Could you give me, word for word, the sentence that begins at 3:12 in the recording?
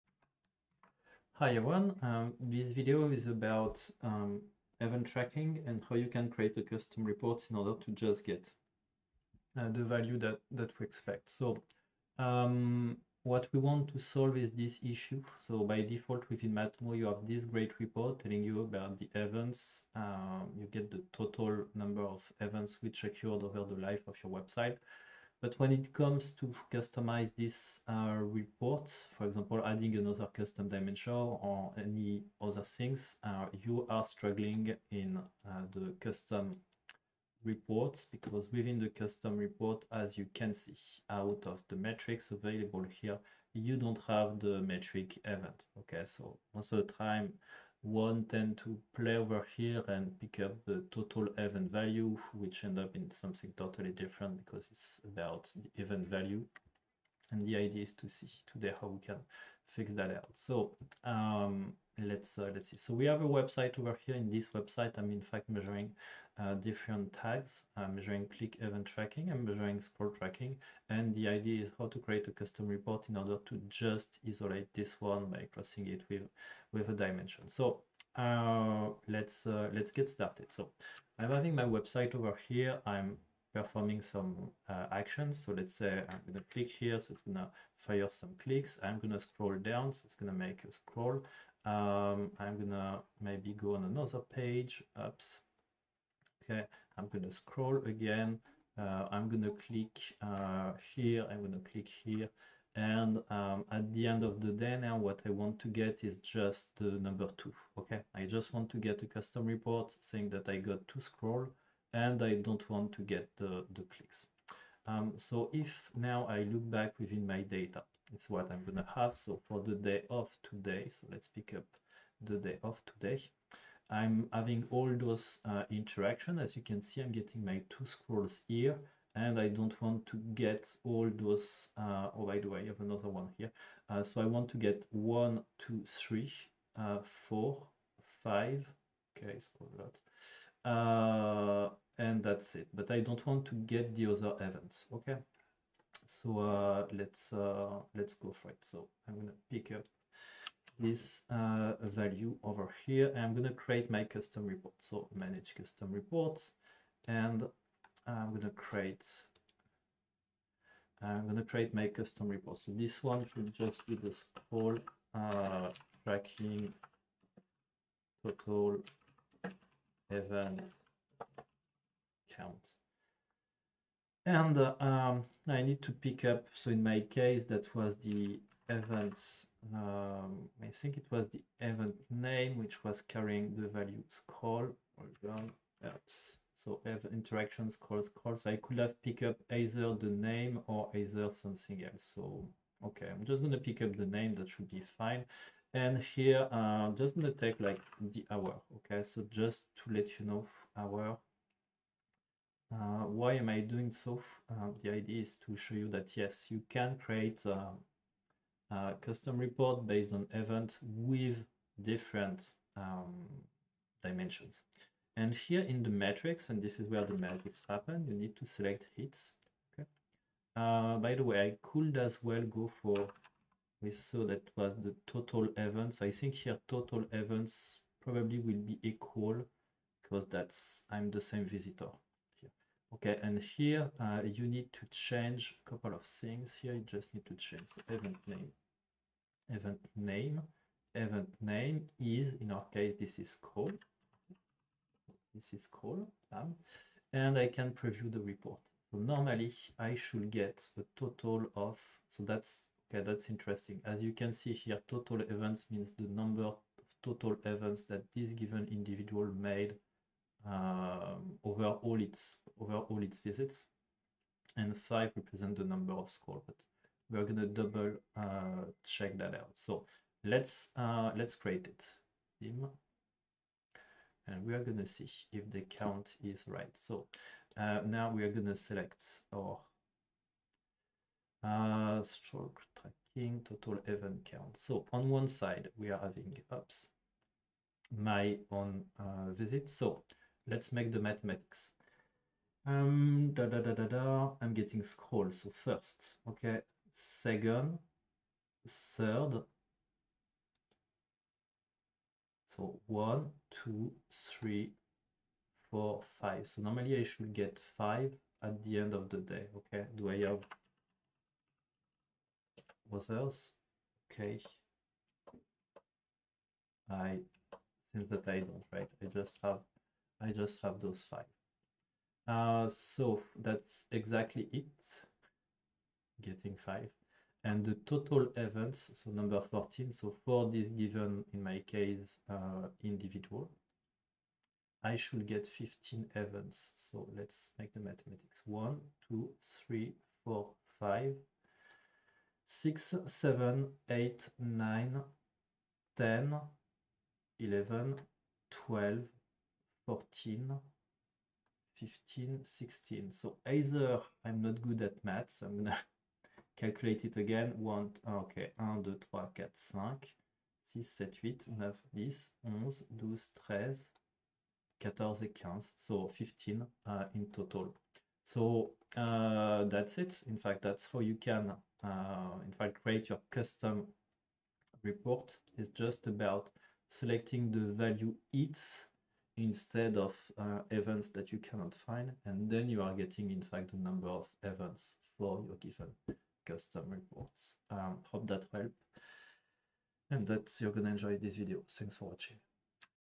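So okay, I'm just gonna pick up the name.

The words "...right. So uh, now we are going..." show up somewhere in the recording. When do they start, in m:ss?
4:36.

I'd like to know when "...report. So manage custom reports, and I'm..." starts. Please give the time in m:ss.
2:34.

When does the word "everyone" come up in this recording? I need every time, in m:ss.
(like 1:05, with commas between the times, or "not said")
0:01.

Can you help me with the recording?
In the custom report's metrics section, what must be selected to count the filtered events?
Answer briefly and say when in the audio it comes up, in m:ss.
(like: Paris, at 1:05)
hits, at 3:38.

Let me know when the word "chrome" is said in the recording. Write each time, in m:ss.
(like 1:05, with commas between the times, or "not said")
not said.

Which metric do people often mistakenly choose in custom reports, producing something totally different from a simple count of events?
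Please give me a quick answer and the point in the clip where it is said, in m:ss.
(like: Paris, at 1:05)
total event value, at 0:50.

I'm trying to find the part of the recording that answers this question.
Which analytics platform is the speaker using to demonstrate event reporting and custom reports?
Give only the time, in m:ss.
0:16.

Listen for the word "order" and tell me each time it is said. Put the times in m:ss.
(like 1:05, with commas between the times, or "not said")
0:07, 1:13.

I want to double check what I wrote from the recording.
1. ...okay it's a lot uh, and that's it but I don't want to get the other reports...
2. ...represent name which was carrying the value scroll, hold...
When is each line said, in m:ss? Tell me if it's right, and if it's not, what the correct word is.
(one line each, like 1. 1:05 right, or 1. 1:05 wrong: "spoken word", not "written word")
1. 2:19 wrong: "events", not "reports"
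2. 3:01 wrong: "event", not "represent".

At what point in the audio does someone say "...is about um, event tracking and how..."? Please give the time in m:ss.
0:03.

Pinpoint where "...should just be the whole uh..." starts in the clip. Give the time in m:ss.
2:43.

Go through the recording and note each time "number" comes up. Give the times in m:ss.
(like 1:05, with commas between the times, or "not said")
0:21, 1:46, 4:16, 4:25, 5:29, 6:23.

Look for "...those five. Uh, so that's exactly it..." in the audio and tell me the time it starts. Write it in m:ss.
5:20.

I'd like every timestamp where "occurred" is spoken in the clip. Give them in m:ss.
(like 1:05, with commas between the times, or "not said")
0:23.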